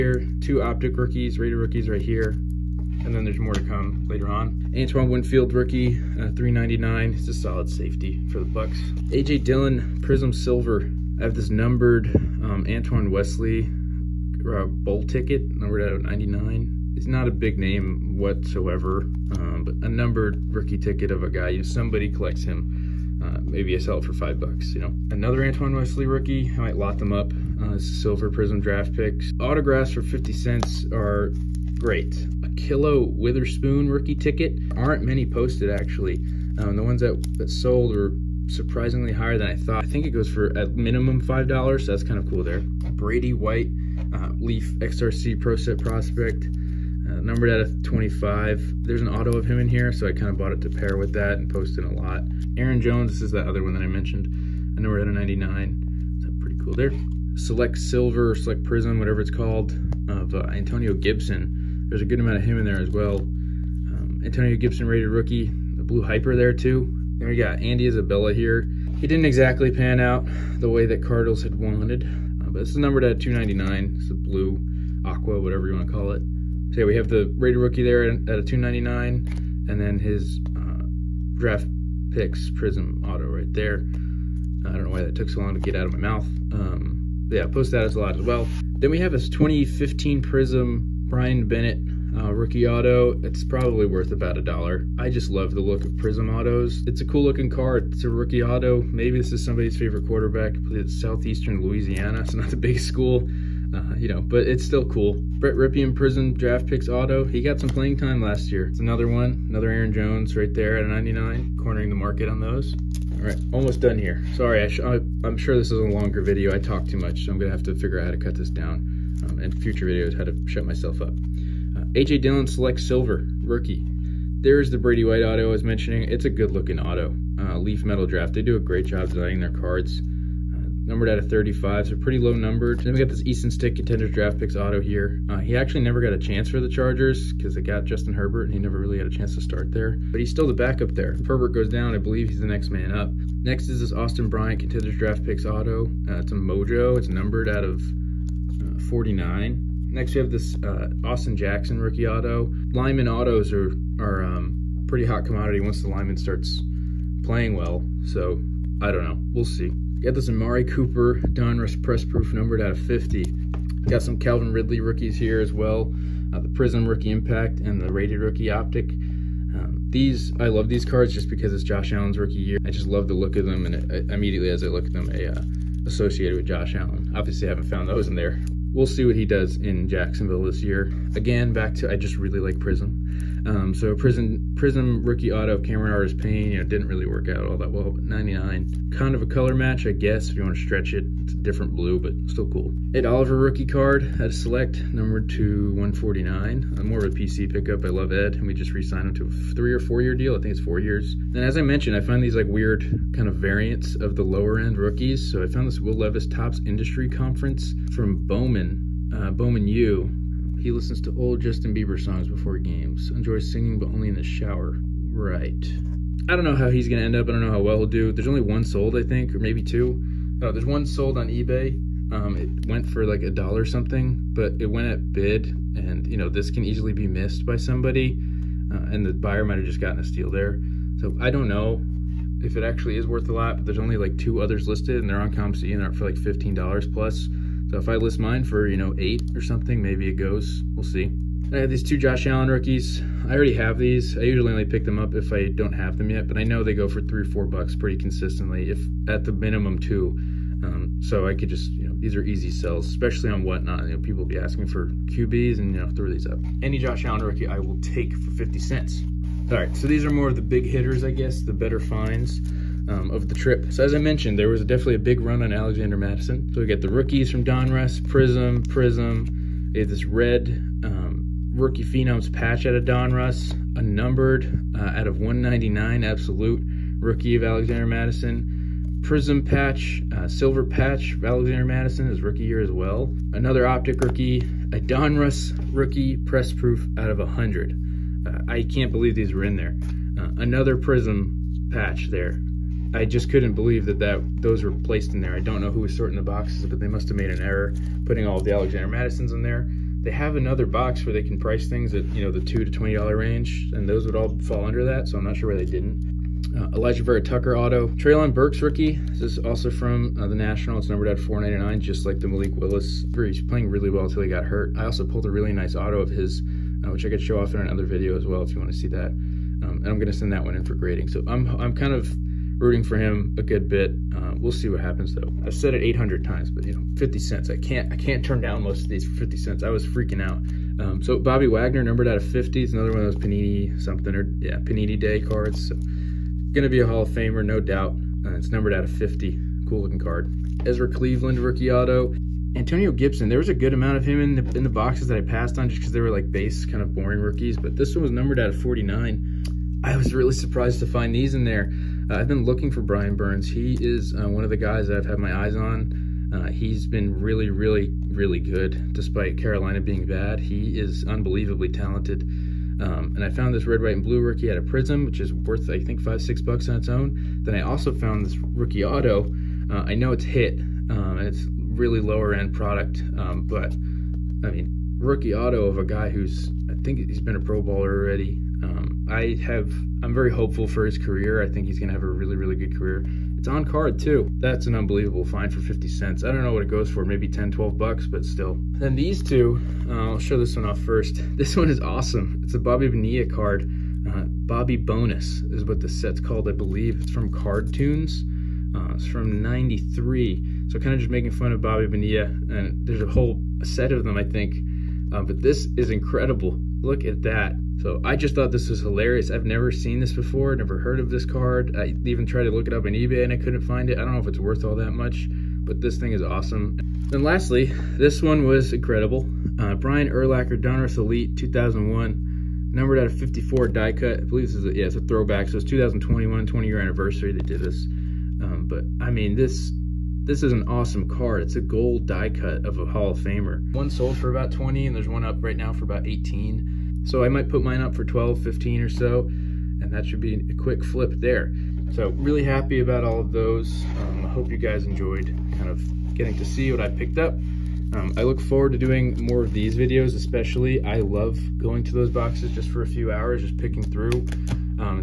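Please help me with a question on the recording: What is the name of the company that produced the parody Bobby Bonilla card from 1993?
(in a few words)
Cardtoons.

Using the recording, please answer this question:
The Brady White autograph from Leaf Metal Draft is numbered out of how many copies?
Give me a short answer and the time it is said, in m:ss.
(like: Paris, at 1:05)
35, at 2:11.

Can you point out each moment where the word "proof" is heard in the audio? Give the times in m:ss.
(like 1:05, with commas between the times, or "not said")
2:42, 4:46.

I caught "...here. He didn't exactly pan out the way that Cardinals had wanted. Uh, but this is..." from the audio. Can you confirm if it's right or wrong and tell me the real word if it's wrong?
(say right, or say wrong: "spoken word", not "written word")
right.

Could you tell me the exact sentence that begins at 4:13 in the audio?
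You know, people be asking for QBs and, you know, throw these up.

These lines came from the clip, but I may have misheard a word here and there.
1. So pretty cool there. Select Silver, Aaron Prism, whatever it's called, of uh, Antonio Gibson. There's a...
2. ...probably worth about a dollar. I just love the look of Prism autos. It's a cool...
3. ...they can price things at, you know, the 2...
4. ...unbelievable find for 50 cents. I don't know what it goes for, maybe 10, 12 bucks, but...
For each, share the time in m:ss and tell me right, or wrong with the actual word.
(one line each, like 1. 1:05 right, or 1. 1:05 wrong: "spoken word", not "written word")
1. 0:56 wrong: "Select", not "Aaron"
2. 1:33 right
3. 5:01 right
4. 6:24 right.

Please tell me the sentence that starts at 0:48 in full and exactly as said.
There's an auto of him in here, so I kind of bought it to pair with that and post in a lot.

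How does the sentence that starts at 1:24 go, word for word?
Uh, I don't know why that took so long to get out of my mouth.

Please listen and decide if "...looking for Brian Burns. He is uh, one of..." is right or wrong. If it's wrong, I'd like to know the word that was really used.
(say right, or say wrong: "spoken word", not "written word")
right.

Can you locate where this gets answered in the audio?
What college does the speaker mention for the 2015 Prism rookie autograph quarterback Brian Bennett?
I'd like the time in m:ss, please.
1:40.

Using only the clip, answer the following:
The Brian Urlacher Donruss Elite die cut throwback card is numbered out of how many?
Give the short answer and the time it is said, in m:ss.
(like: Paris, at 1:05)
54, at 7:03.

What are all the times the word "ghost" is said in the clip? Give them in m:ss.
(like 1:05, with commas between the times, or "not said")
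not said.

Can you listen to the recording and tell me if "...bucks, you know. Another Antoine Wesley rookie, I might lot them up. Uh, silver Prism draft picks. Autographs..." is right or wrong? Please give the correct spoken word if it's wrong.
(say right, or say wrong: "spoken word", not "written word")
right.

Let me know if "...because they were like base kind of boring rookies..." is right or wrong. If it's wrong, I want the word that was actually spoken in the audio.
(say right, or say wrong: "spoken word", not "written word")
right.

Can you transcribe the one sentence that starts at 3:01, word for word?
Again, back to I just really like Prism.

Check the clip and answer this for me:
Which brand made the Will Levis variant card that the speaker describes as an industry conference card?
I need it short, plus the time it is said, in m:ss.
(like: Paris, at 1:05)
Topps, at 3:26.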